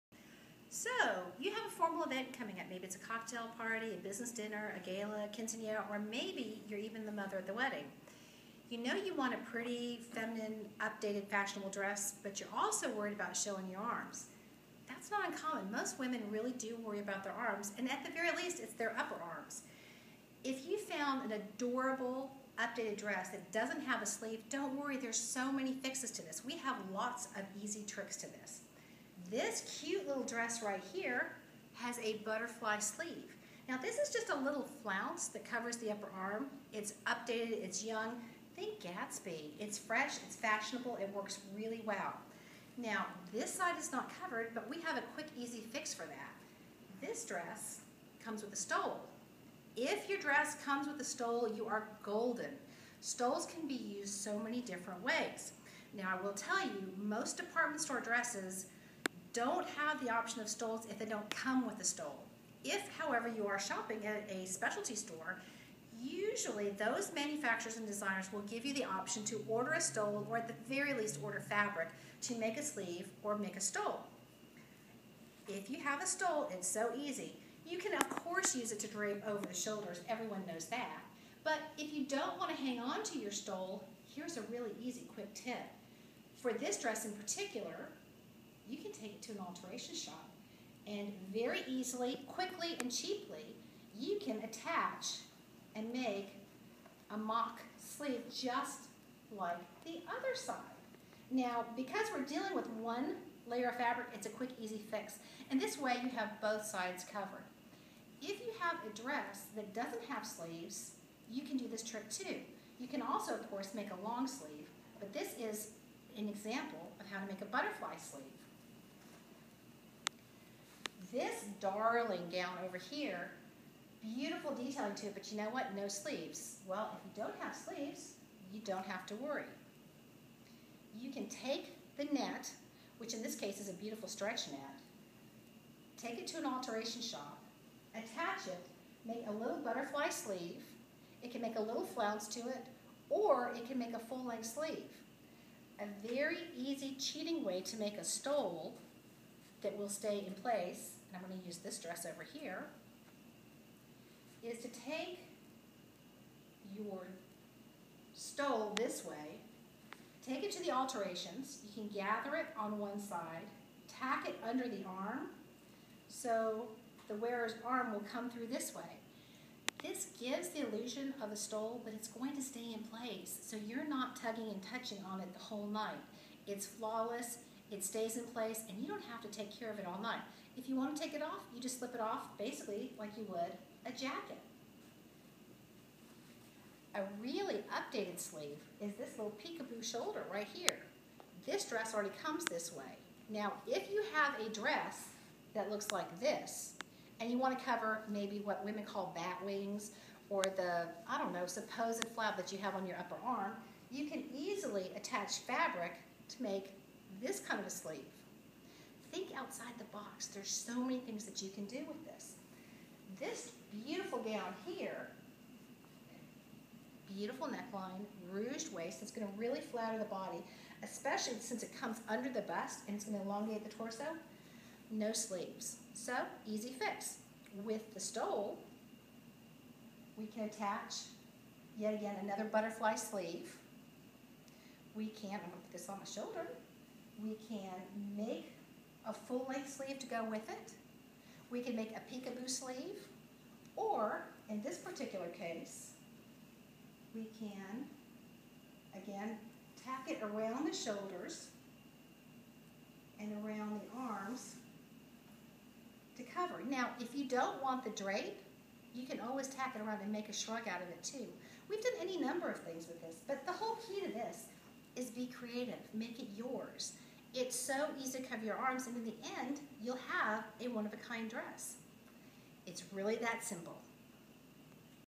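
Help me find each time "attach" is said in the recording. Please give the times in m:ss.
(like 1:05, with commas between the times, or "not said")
1:34, 2:17, 3:24, 3:50.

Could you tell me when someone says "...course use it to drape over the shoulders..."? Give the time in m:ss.
1:18.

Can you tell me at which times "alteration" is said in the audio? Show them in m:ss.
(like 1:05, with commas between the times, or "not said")
1:29, 2:16, 2:40.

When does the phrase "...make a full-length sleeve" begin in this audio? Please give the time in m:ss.
2:23.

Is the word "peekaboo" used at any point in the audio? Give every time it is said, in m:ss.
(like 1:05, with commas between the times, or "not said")
3:09, 4:02.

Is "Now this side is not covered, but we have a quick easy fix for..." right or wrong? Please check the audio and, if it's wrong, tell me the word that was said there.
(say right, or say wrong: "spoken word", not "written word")
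right.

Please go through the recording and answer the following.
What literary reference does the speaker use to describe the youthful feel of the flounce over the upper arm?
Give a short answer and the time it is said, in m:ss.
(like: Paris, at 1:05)
Gatsby, at 0:38.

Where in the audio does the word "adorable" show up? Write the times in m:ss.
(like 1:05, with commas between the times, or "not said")
0:21.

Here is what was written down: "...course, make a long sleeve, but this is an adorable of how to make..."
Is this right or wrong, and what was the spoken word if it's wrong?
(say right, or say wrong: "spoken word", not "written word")
wrong: "example", not "adorable".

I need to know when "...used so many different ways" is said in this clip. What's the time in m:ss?
0:53.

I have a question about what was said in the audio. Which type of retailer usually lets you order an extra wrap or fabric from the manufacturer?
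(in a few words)
Specialty store.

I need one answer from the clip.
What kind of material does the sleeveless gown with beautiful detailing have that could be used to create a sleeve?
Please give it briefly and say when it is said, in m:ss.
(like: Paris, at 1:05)
Stretch net, at 2:14.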